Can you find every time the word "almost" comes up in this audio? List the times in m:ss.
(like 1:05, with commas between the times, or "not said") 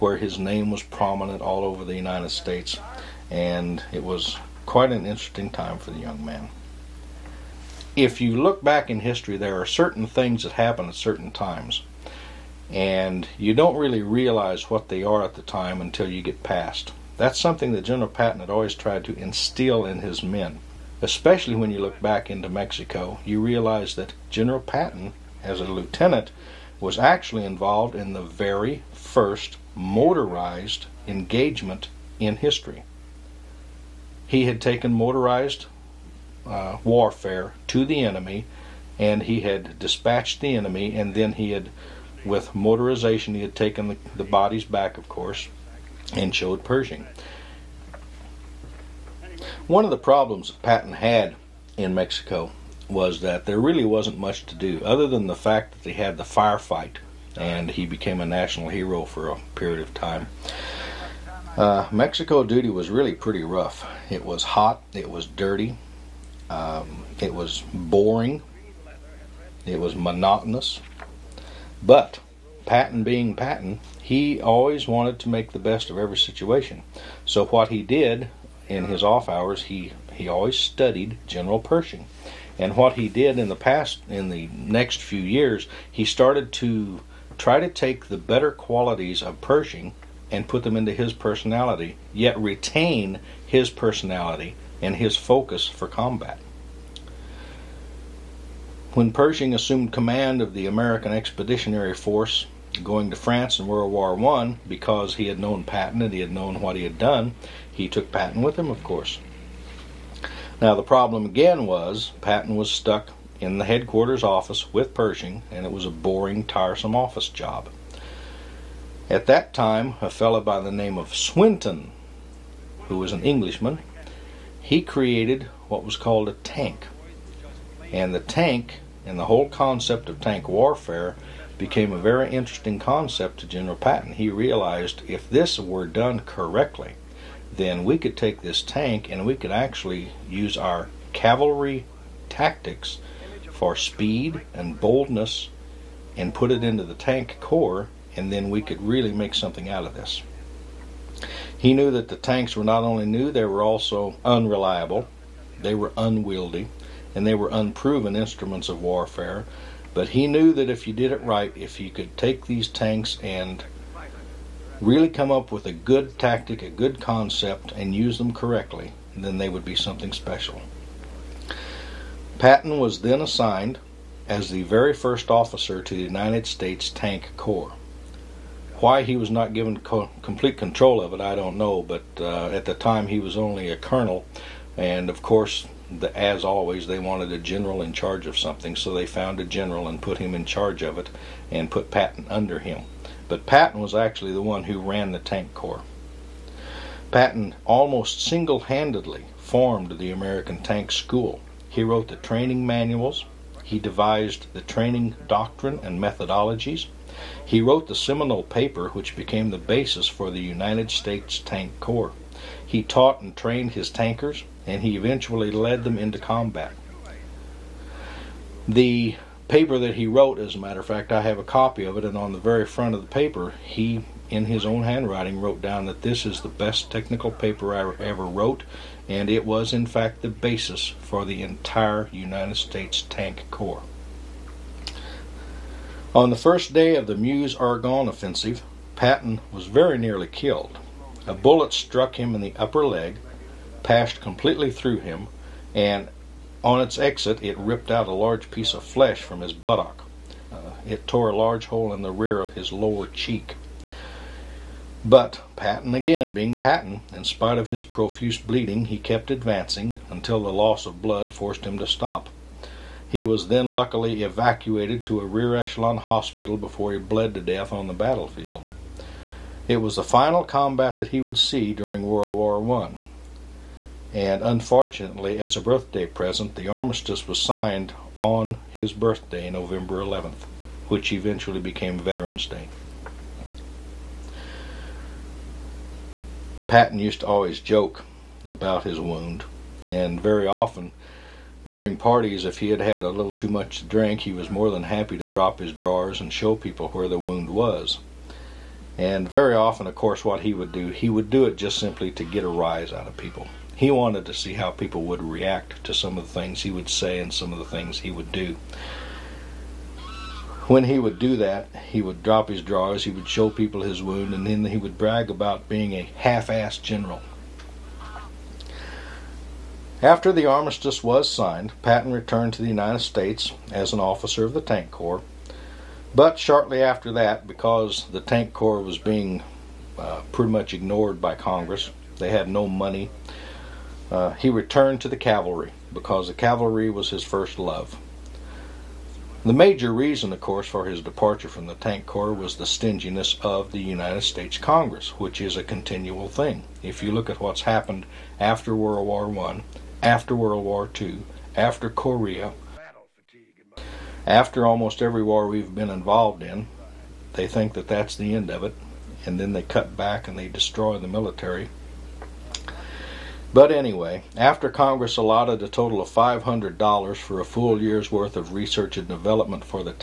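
3:17, 5:54.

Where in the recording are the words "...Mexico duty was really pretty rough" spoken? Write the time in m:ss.
1:01.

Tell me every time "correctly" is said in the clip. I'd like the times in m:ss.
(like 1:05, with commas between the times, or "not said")
2:16, 2:48.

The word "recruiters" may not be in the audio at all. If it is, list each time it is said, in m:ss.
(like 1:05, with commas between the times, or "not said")
not said.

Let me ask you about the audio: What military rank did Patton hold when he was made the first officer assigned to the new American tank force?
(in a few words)
Colonel.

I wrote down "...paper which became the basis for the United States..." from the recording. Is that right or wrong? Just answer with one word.
right.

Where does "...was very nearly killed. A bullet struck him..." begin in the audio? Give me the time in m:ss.
3:59.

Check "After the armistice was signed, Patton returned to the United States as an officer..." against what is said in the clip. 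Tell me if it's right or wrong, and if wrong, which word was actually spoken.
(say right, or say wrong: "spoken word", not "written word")
right.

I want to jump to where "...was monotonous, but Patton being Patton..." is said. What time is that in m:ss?
1:09.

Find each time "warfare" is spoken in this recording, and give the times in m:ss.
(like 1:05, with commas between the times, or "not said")
0:36, 2:10, 2:38.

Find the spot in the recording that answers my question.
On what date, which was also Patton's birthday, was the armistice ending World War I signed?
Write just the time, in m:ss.
4:39.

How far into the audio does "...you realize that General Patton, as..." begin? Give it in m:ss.
0:23.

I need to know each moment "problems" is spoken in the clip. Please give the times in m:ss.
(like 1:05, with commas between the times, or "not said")
0:49, 1:50.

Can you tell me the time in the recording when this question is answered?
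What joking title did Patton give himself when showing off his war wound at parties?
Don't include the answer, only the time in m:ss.
5:16.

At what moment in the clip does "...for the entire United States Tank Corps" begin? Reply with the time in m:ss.
3:51.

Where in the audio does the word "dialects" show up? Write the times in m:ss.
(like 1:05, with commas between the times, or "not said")
not said.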